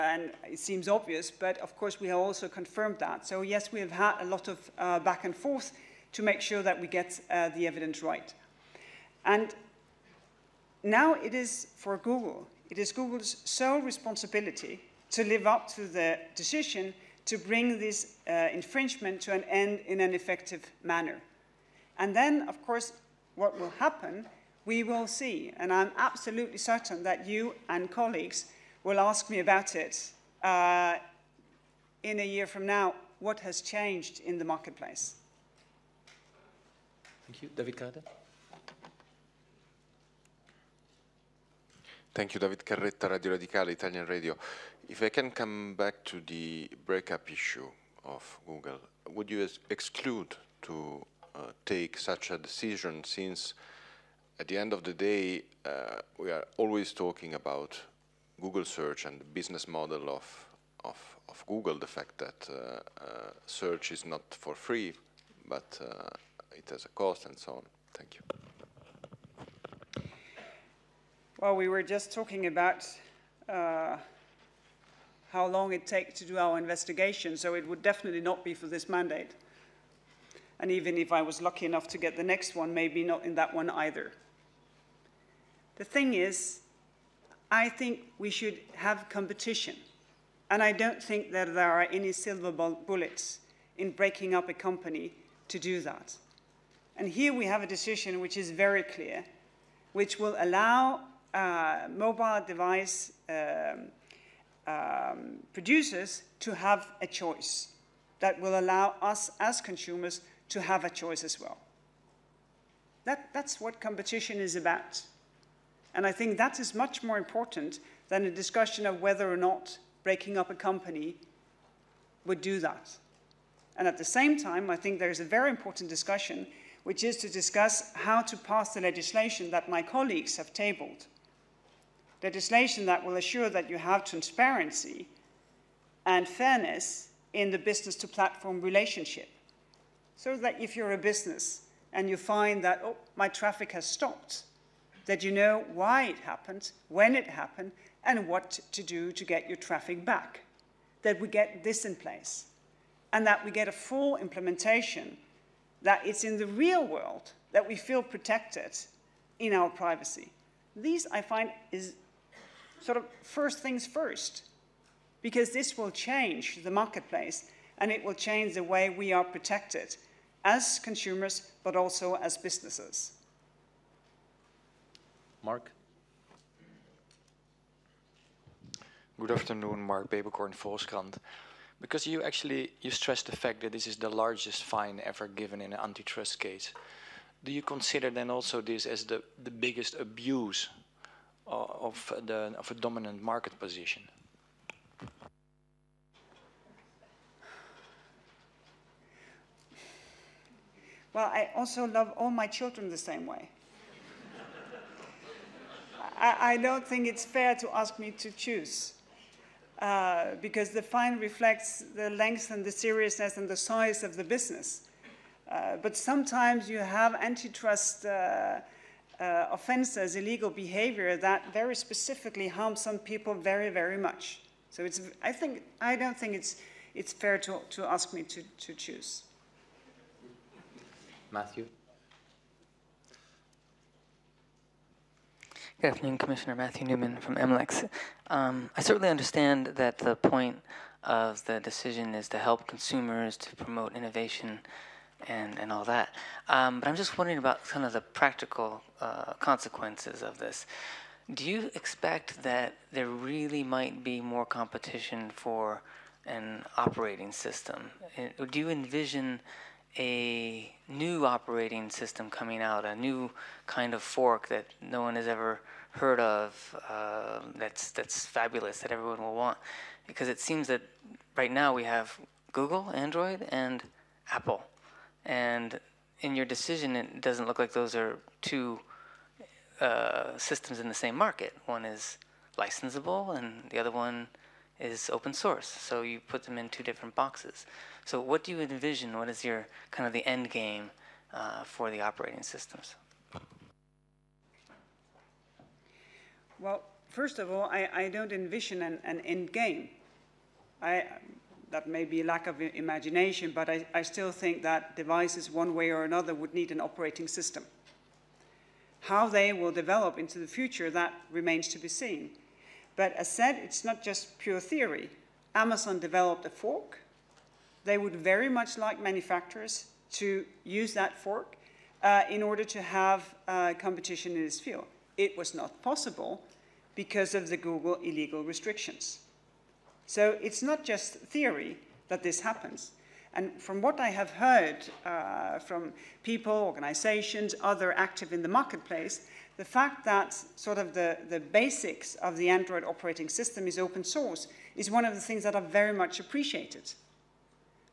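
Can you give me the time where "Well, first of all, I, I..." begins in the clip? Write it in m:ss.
4:56.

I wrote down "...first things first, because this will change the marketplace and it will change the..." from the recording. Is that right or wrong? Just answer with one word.
right.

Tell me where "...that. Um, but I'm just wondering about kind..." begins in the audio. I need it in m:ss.
4:05.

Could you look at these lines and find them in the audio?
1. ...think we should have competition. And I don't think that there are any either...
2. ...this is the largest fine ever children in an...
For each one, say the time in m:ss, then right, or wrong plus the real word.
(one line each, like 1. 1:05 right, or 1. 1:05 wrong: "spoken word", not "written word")
1. 1:27 wrong: "silver", not "either"
2. 3:03 wrong: "given", not "children".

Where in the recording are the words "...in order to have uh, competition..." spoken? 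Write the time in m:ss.
5:22.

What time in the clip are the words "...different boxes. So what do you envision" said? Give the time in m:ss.
4:46.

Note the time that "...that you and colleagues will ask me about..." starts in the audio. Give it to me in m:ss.
0:27.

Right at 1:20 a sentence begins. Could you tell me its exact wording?
And even if I was lucky enough to get the next one, maybe not in that one either.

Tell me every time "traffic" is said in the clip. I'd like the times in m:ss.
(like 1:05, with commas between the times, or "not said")
2:23, 2:29.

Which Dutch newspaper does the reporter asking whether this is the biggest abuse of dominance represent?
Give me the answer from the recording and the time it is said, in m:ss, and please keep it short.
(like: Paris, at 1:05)
Volkskrant, at 3:00.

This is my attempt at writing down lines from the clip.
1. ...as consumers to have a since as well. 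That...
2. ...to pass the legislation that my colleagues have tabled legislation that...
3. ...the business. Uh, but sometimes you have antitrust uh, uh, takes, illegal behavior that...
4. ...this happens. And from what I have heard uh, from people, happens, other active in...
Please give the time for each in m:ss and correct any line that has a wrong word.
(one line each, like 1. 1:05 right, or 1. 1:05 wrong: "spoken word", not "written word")
1. 1:49 wrong: "choice", not "since"
2. 2:08 right
3. 3:34 wrong: "offenses", not "takes"
4. 5:32 wrong: "organizations", not "happens".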